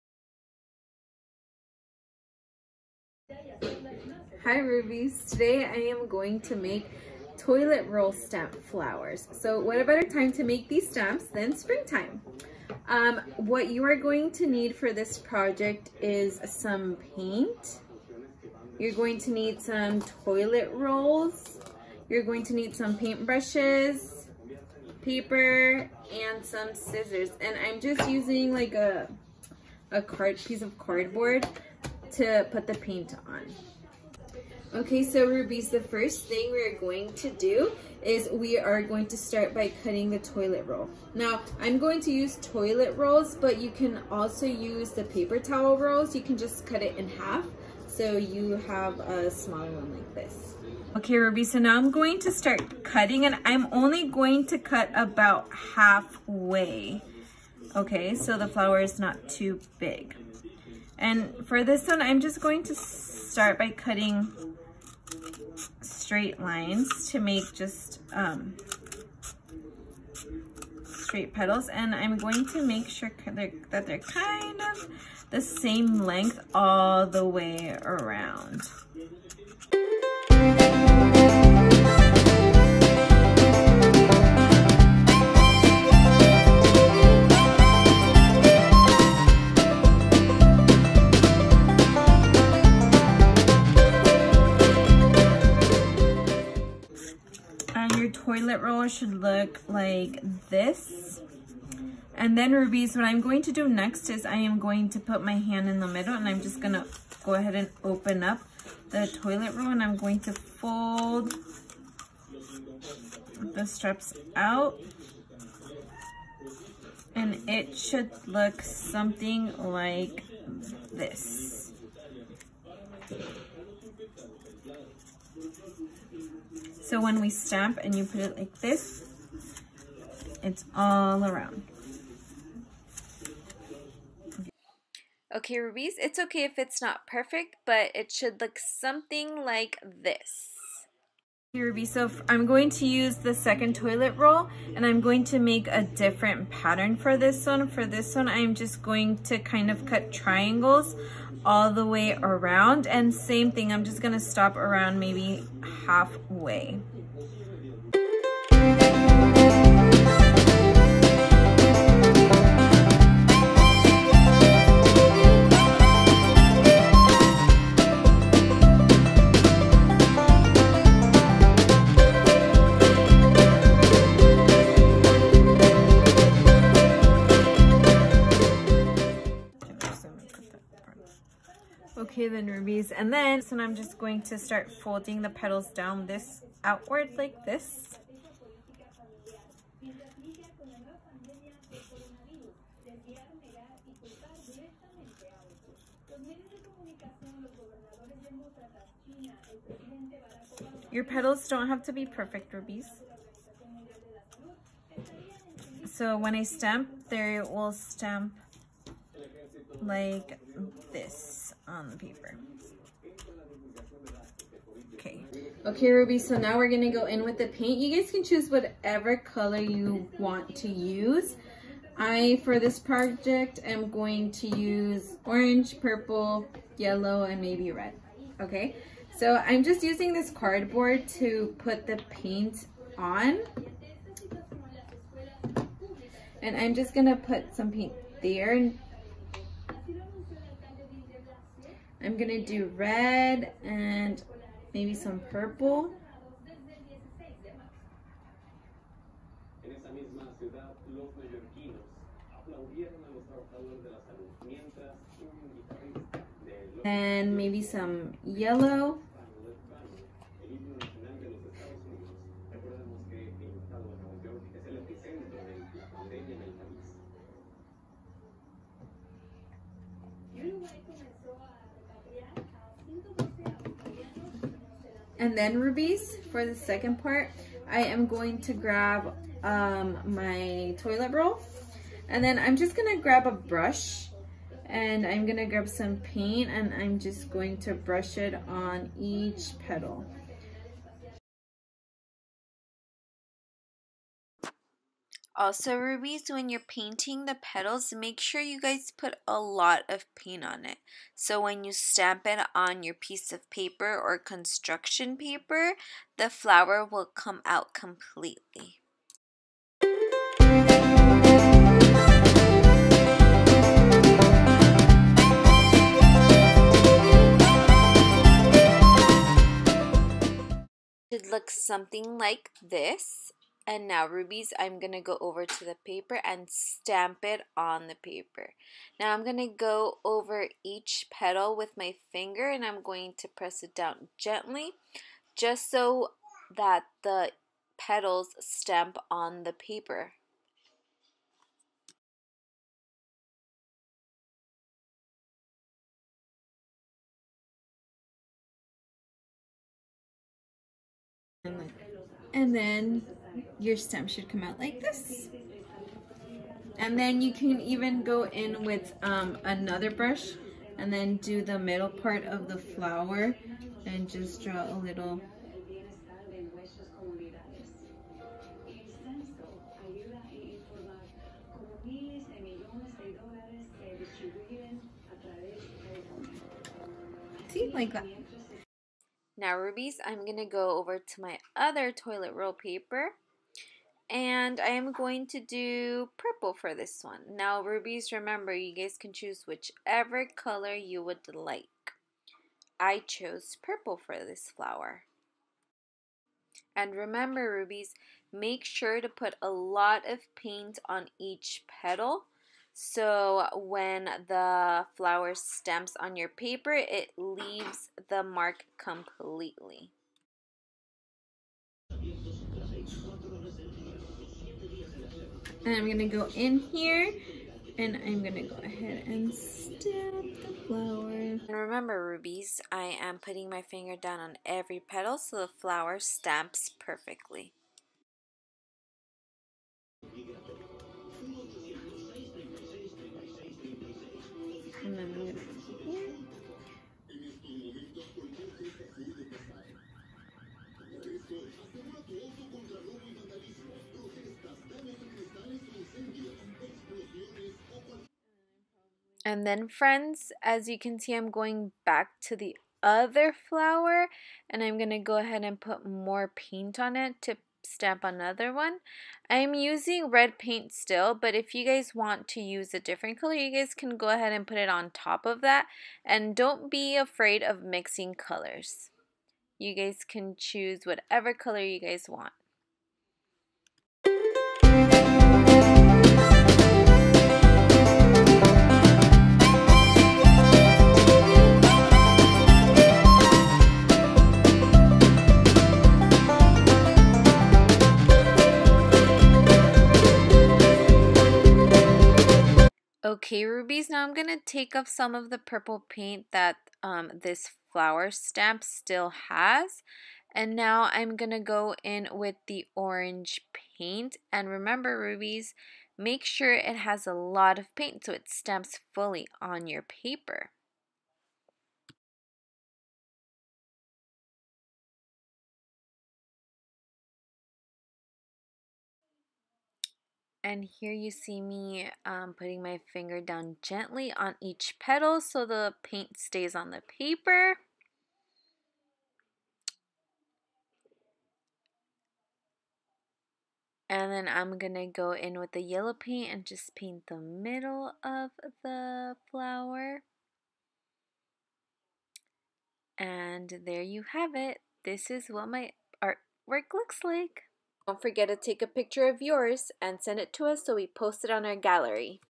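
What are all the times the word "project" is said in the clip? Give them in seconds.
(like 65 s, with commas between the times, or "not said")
15 s, 222 s.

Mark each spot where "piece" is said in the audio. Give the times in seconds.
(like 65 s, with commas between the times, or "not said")
30 s, 302 s.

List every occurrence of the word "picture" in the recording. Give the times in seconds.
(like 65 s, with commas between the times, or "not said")
548 s.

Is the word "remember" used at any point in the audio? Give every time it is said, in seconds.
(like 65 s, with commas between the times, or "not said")
388 s, 396 s, 421 s, 504 s.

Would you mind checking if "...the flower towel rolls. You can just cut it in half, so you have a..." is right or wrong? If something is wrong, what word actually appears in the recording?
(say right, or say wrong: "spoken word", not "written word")
wrong: "paper", not "flower".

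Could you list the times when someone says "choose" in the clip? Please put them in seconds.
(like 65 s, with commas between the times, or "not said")
218 s, 389 s, 470 s.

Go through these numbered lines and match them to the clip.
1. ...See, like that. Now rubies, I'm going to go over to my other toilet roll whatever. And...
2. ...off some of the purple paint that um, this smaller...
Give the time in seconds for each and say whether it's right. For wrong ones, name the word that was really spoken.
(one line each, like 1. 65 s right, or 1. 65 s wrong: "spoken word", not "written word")
1. 377 s wrong: "paper", not "whatever"
2. 494 s wrong: "flower", not "smaller".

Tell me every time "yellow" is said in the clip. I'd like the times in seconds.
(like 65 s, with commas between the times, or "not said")
226 s, 258 s, 535 s.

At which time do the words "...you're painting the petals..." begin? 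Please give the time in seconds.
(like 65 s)
296 s.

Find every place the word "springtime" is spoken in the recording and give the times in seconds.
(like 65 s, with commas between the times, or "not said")
11 s.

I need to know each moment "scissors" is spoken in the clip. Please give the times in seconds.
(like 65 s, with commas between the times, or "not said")
26 s.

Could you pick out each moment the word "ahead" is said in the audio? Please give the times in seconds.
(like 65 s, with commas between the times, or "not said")
107 s, 418 s, 455 s, 464 s.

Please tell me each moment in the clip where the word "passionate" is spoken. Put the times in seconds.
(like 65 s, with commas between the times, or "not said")
not said.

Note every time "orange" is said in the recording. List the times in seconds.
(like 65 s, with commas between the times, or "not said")
225 s, 502 s.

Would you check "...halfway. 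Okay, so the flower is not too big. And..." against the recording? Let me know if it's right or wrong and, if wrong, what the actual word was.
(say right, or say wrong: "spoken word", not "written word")
right.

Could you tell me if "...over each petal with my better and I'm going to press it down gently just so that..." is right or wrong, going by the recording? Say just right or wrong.
wrong.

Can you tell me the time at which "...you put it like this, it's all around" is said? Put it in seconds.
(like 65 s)
127 s.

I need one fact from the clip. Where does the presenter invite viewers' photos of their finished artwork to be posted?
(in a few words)
gallery.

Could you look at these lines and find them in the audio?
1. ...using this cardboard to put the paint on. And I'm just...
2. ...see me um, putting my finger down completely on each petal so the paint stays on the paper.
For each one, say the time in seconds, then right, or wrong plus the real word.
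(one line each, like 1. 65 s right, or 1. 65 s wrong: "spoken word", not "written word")
1. 229 s right
2. 521 s wrong: "gently", not "completely".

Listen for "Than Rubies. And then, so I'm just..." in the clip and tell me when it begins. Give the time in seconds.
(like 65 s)
182 s.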